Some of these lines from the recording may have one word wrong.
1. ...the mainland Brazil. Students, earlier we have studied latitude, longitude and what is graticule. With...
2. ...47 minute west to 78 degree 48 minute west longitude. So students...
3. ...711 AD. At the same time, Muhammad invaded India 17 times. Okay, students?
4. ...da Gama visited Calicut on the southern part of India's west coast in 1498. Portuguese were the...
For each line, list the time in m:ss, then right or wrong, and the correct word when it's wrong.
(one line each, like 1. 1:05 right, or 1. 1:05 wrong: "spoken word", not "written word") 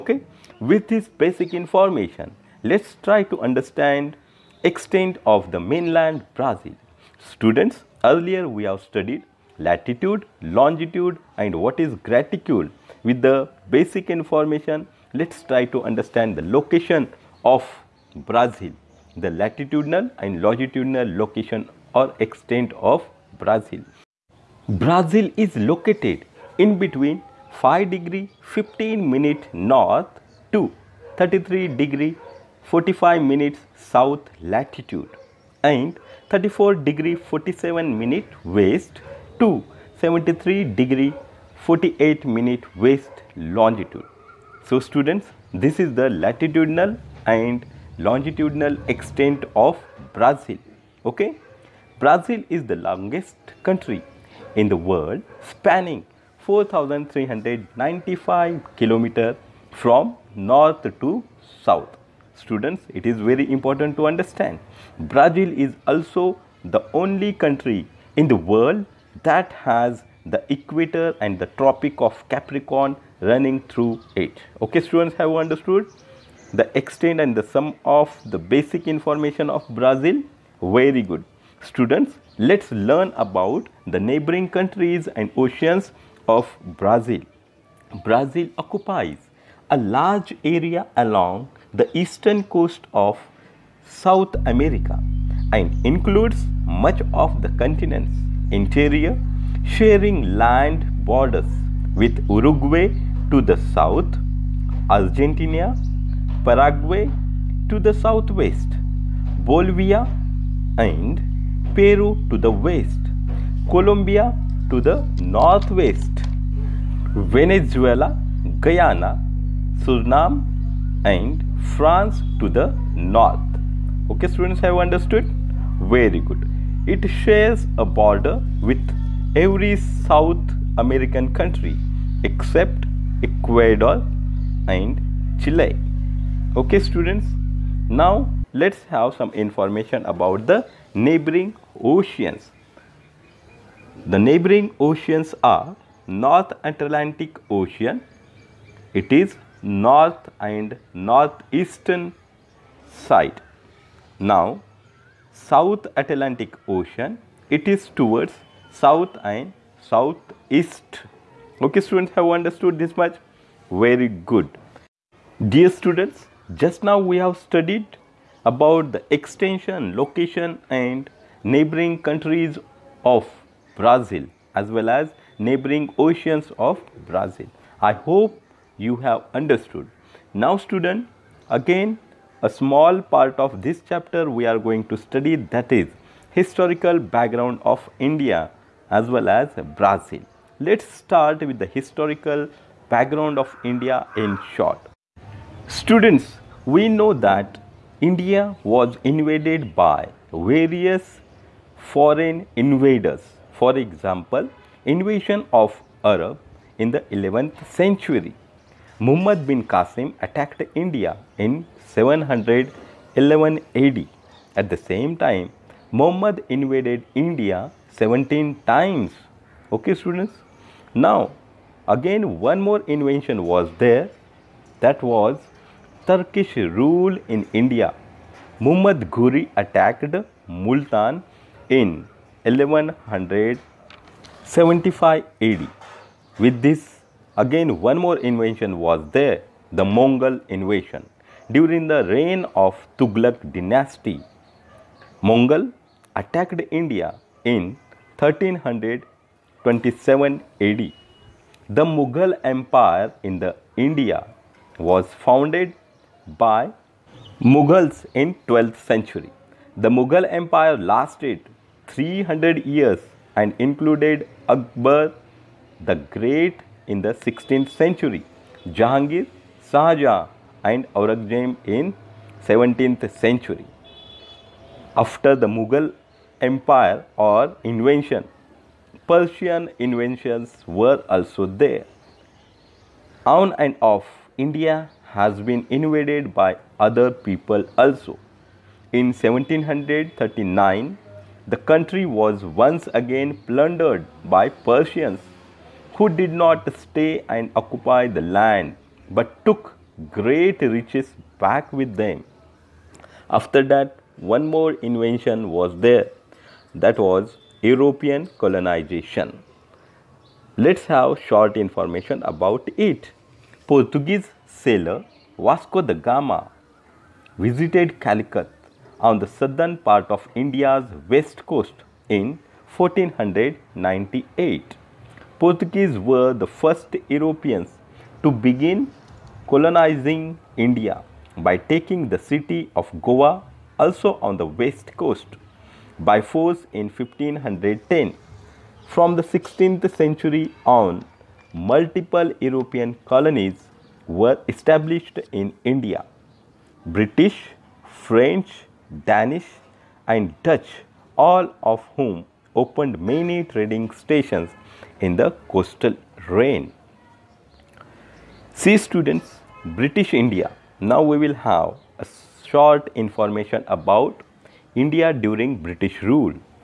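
1. 0:05 right
2. 0:37 wrong: "73", not "78"
3. 3:31 right
4. 5:15 right.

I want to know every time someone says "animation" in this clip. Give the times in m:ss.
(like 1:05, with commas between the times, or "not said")
not said.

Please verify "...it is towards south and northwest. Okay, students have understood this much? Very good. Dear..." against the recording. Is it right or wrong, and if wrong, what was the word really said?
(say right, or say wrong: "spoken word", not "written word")
wrong: "southeast", not "northwest".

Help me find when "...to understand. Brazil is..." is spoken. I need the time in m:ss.
1:03.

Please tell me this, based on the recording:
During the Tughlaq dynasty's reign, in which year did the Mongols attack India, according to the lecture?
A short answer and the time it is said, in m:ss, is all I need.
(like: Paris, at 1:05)
1327 AD, at 4:08.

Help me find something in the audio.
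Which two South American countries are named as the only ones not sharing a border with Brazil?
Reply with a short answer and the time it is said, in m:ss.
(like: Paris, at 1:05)
Ecuador and Chile, at 2:13.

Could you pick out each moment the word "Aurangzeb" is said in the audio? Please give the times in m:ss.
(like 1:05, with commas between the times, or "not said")
4:31.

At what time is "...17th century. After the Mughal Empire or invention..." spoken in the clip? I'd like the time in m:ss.
4:32.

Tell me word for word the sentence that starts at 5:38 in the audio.
From the 16th century on, multiple European colonies were established in India.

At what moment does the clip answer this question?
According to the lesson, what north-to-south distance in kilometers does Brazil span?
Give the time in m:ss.
0:56.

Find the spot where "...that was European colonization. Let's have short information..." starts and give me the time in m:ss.
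5:06.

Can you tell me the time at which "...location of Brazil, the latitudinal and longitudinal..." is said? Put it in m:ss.
0:16.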